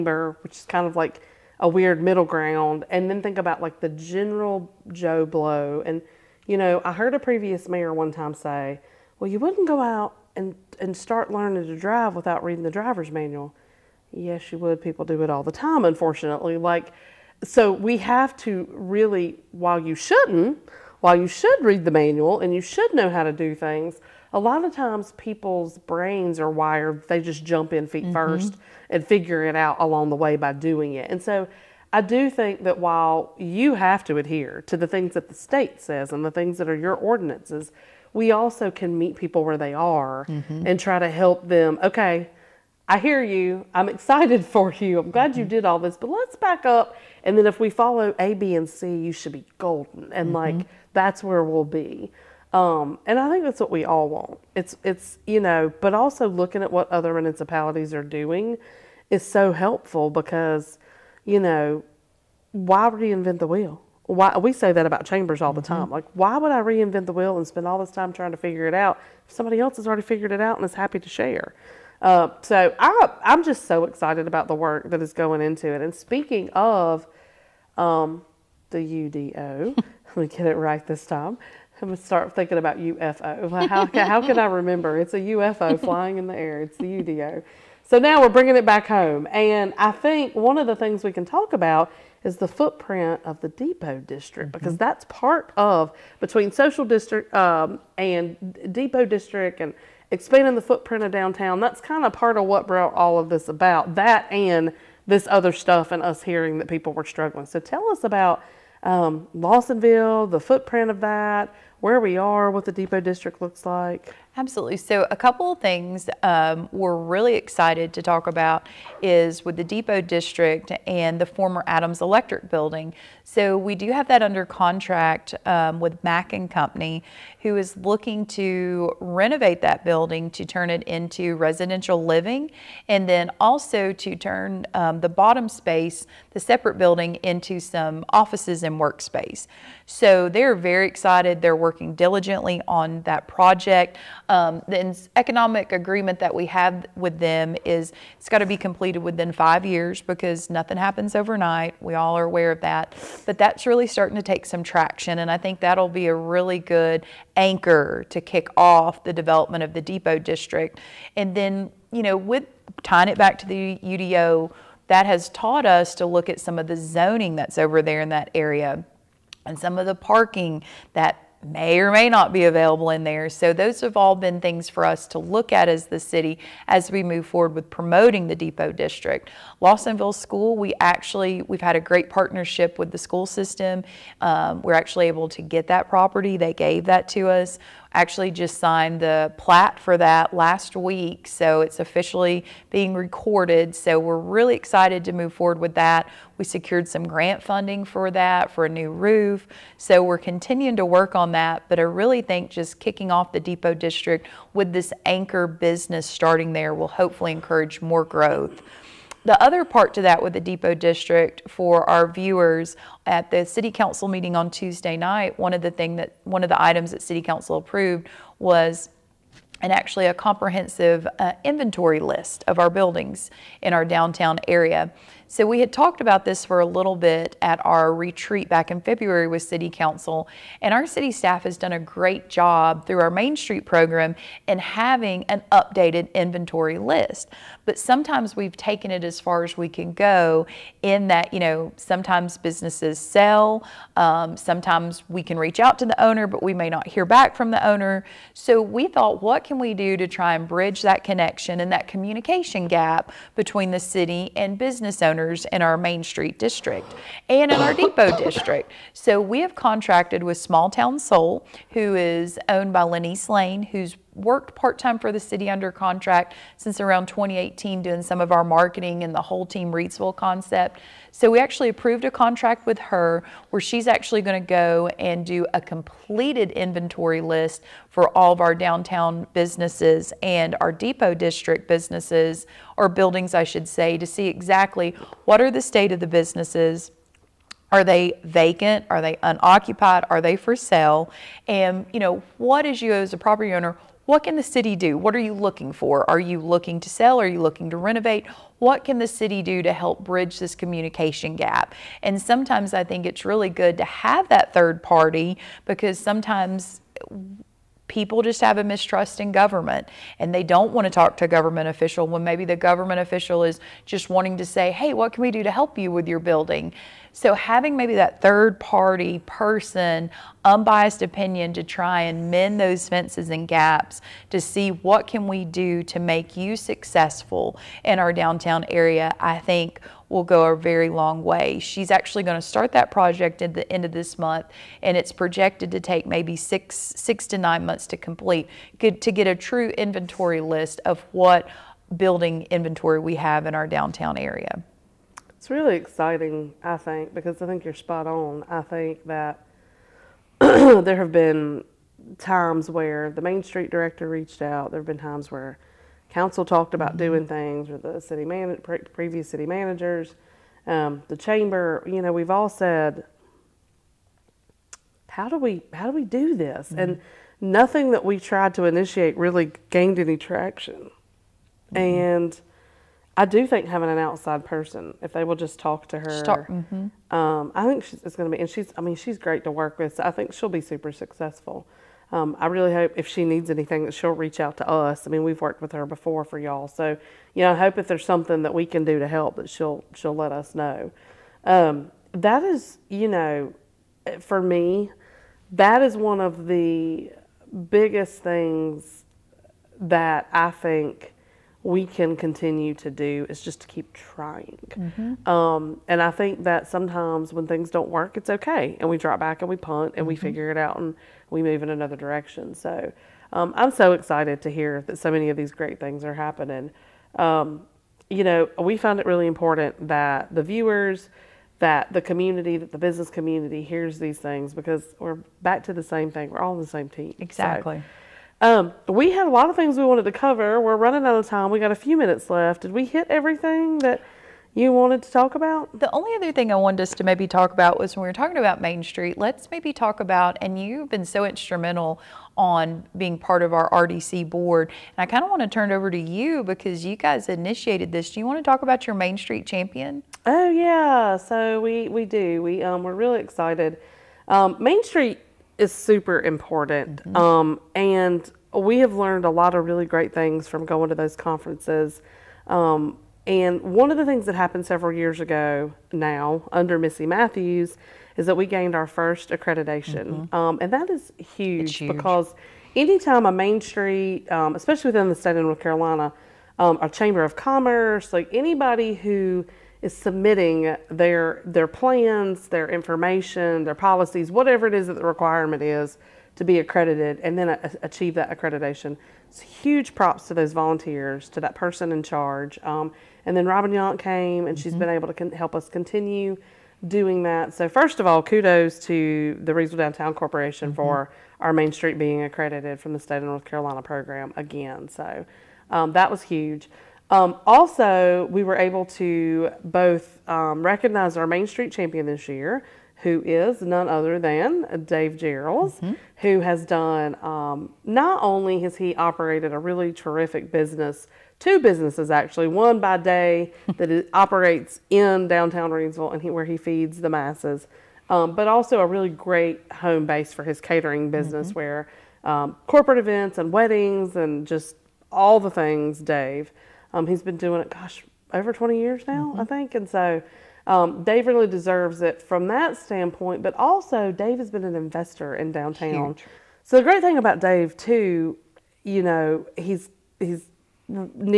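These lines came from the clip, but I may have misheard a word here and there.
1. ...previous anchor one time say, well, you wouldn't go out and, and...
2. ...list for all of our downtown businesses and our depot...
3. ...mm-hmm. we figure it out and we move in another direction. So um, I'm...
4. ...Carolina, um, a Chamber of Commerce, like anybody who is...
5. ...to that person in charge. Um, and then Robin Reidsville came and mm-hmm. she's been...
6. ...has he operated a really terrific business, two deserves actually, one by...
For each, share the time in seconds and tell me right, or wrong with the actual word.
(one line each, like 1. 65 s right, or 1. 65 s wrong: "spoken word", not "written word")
1. 7 s wrong: "mayor", not "anchor"
2. 277 s right
3. 410 s right
4. 475 s right
5. 491 s wrong: "Yonk", not "Reidsville"
6. 518 s wrong: "businesses", not "deserves".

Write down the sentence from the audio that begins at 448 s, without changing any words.
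Do you want to talk about your Main Street champion?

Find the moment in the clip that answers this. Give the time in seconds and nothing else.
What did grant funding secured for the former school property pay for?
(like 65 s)
198 s.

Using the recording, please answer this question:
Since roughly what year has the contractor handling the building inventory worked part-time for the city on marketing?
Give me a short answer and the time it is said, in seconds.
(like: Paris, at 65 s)
2018, at 267 s.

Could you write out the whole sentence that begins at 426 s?
We're all on the same team.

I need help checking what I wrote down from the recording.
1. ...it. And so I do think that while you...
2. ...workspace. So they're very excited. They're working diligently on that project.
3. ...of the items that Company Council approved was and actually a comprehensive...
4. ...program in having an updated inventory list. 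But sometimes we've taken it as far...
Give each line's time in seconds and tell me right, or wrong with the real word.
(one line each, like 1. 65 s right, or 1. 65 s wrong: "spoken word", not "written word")
1. 30 s right
2. 138 s right
3. 216 s wrong: "City", not "Company"
4. 233 s right.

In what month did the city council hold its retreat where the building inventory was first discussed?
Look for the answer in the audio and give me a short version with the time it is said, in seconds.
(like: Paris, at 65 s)
February, at 228 s.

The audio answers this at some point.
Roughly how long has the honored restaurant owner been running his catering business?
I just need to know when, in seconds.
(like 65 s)
538 s.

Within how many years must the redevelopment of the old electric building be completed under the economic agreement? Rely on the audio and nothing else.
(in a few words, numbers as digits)
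5 years.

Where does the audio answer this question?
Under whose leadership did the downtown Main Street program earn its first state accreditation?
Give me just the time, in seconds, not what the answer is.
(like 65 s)
466 s.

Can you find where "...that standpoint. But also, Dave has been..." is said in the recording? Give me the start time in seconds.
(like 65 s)
542 s.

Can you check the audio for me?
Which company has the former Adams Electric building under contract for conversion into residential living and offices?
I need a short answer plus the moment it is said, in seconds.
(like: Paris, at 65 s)
Mack and Company, at 126 s.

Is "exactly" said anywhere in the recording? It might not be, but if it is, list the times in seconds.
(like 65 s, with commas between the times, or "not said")
284 s, 427 s.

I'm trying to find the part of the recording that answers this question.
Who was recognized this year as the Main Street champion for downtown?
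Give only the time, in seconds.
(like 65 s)
514 s.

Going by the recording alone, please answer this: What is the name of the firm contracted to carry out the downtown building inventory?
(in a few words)
Small Town Soul.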